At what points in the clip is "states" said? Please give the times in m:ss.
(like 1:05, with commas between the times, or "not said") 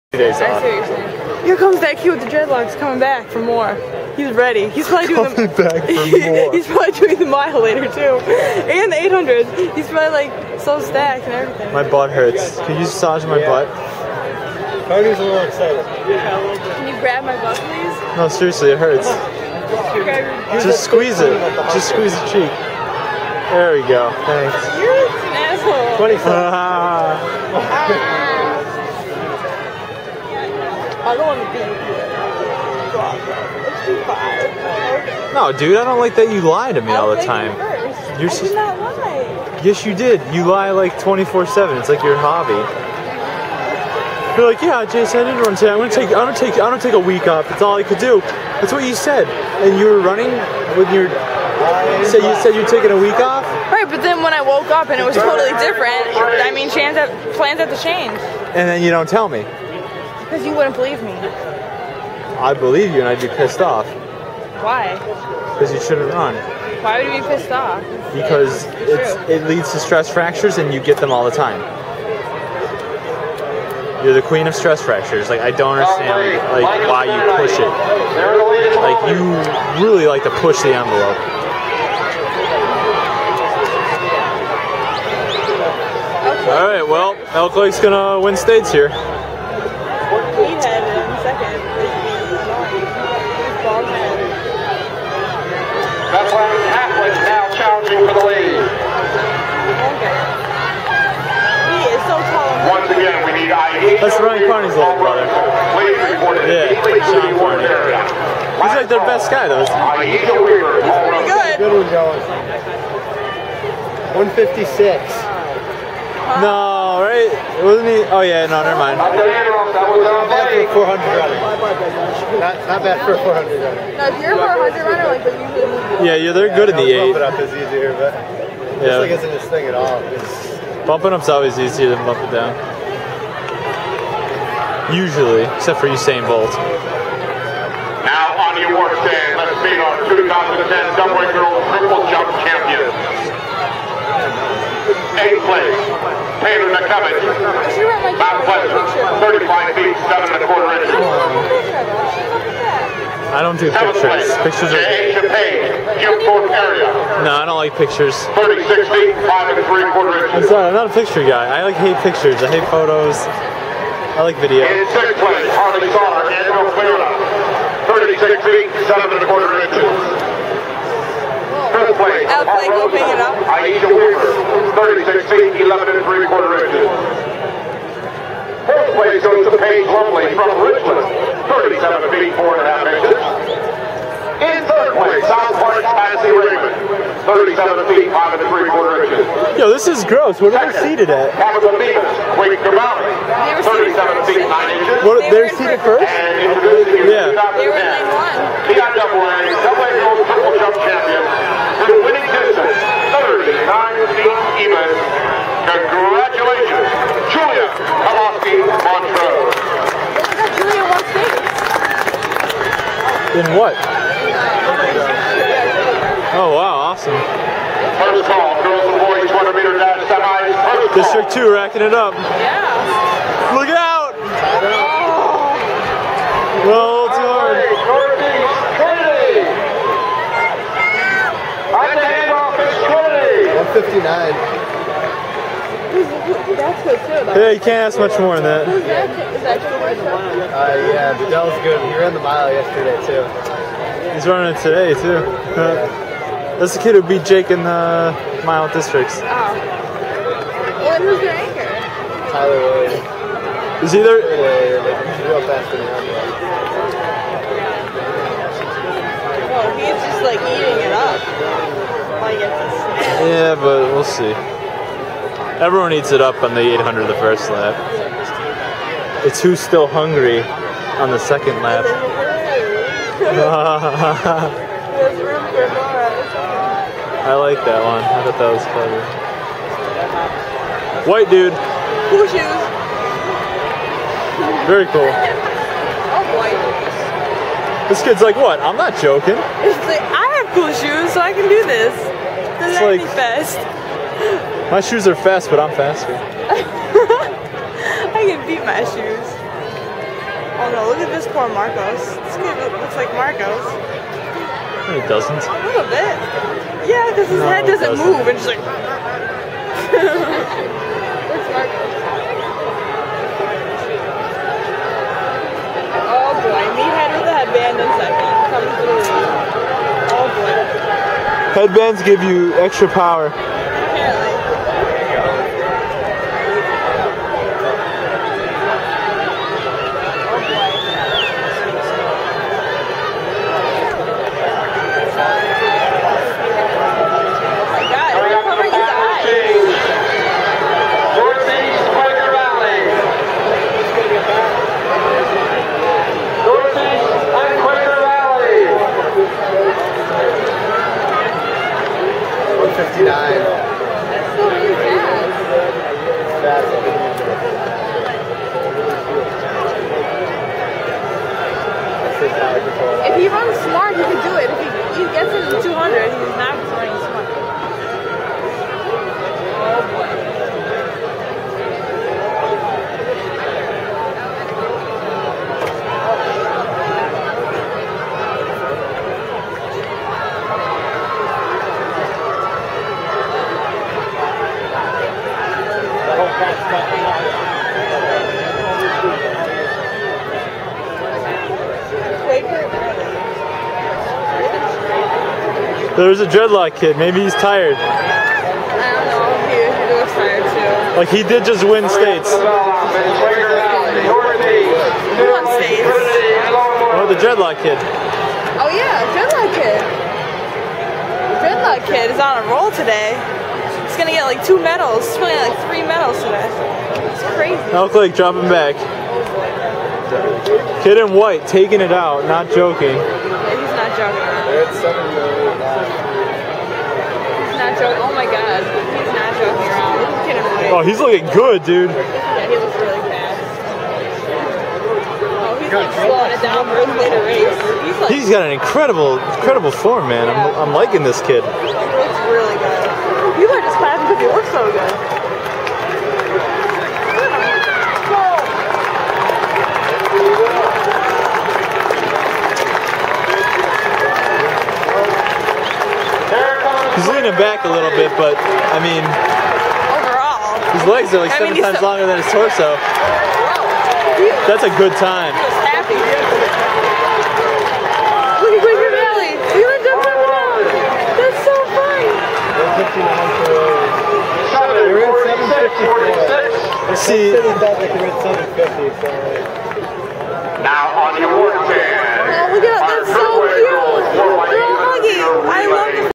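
1:28, 6:41.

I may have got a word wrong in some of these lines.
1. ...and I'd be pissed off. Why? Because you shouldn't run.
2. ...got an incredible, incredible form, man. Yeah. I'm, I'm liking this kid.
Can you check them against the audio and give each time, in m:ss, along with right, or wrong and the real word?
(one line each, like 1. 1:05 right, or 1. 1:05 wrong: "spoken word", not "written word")
1. 1:02 right
2. 7:18 right.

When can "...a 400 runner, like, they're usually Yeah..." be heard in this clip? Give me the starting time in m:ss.
2:04.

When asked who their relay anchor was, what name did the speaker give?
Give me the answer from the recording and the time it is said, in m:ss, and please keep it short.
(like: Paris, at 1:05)
Tyler Wade, at 4:12.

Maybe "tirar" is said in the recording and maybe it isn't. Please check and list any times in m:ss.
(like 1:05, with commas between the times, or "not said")
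5:53.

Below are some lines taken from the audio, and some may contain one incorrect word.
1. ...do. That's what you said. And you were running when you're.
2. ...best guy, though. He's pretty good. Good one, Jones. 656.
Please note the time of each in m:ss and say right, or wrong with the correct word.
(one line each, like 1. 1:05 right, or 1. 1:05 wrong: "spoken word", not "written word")
1. 0:47 right
2. 1:48 wrong: "156", not "656".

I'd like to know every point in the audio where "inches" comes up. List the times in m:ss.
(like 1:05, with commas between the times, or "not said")
2:30, 2:40, 2:49, 2:56, 3:02, 3:09, 3:14.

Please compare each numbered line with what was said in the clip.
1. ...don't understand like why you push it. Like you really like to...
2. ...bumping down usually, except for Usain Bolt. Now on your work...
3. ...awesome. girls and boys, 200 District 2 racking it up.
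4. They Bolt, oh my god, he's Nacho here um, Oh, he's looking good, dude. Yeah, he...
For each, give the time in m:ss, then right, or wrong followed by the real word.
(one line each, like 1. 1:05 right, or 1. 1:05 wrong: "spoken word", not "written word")
1. 1:15 right
2. 2:12 right
3. 3:36 right
4. 7:04 wrong: "Nacho", not "Bolt".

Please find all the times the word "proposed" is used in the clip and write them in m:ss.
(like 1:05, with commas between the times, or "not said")
not said.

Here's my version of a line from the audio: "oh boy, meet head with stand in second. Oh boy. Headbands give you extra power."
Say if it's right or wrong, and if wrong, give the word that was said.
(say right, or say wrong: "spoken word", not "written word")
wrong: "headband", not "stand".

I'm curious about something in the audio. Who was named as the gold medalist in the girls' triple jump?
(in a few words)
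Julia Kowalski.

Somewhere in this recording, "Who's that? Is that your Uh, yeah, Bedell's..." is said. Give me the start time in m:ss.
3:58.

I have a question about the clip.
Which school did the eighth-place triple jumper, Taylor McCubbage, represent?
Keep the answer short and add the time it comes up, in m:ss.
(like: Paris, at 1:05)
Mount Pleasant, at 2:28.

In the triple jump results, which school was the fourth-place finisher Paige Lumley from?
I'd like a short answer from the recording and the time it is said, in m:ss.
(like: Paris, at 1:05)
Richmond, at 3:00.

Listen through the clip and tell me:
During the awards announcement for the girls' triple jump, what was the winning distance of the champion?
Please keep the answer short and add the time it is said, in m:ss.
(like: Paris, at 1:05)
39 feet, at 3:23.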